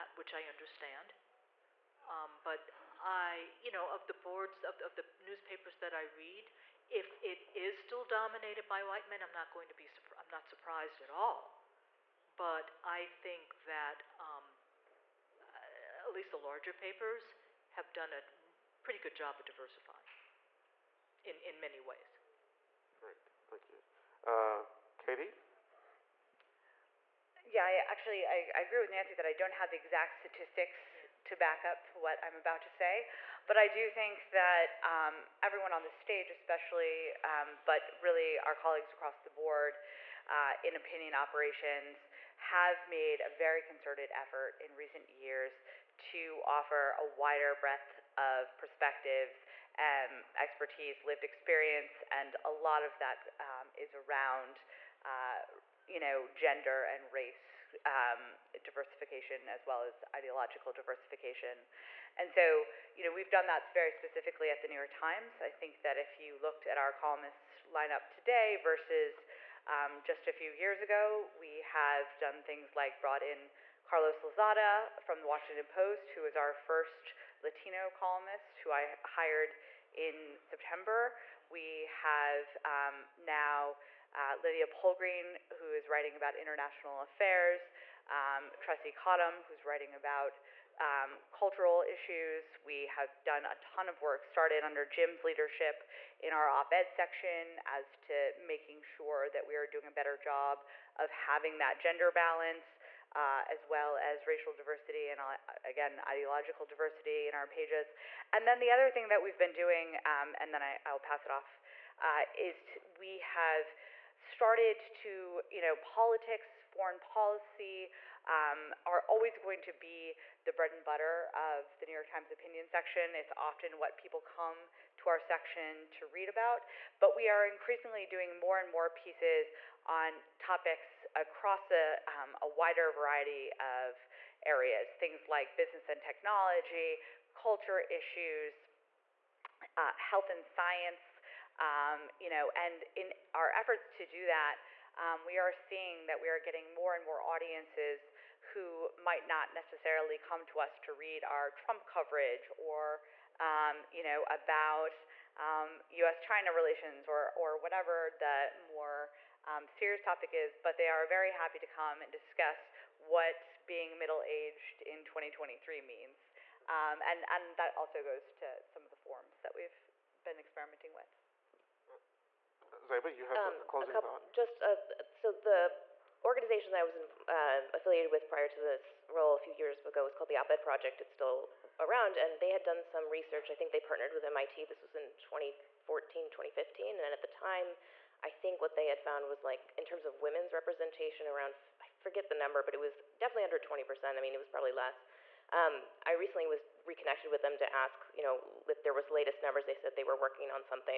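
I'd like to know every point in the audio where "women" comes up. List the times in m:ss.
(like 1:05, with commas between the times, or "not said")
3:10.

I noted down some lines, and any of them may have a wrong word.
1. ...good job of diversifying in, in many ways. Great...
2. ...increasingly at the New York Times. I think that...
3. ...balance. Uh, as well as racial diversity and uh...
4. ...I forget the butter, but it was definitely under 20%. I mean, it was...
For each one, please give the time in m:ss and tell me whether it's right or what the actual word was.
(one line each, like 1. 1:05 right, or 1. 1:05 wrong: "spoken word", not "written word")
1. 0:18 right
2. 1:03 wrong: "specifically", not "increasingly"
3. 1:42 right
4. 3:11 wrong: "number", not "butter".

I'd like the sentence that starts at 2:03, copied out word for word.
It's often what people come to our section to read about.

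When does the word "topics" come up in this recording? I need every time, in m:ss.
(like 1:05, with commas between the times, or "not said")
2:10, 2:40.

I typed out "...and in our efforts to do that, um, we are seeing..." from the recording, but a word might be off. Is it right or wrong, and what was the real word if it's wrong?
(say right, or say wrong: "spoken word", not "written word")
right.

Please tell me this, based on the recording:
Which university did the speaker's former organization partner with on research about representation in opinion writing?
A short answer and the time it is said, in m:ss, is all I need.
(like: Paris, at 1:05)
MIT, at 3:04.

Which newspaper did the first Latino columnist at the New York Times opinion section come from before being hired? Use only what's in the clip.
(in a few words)
Washington Post.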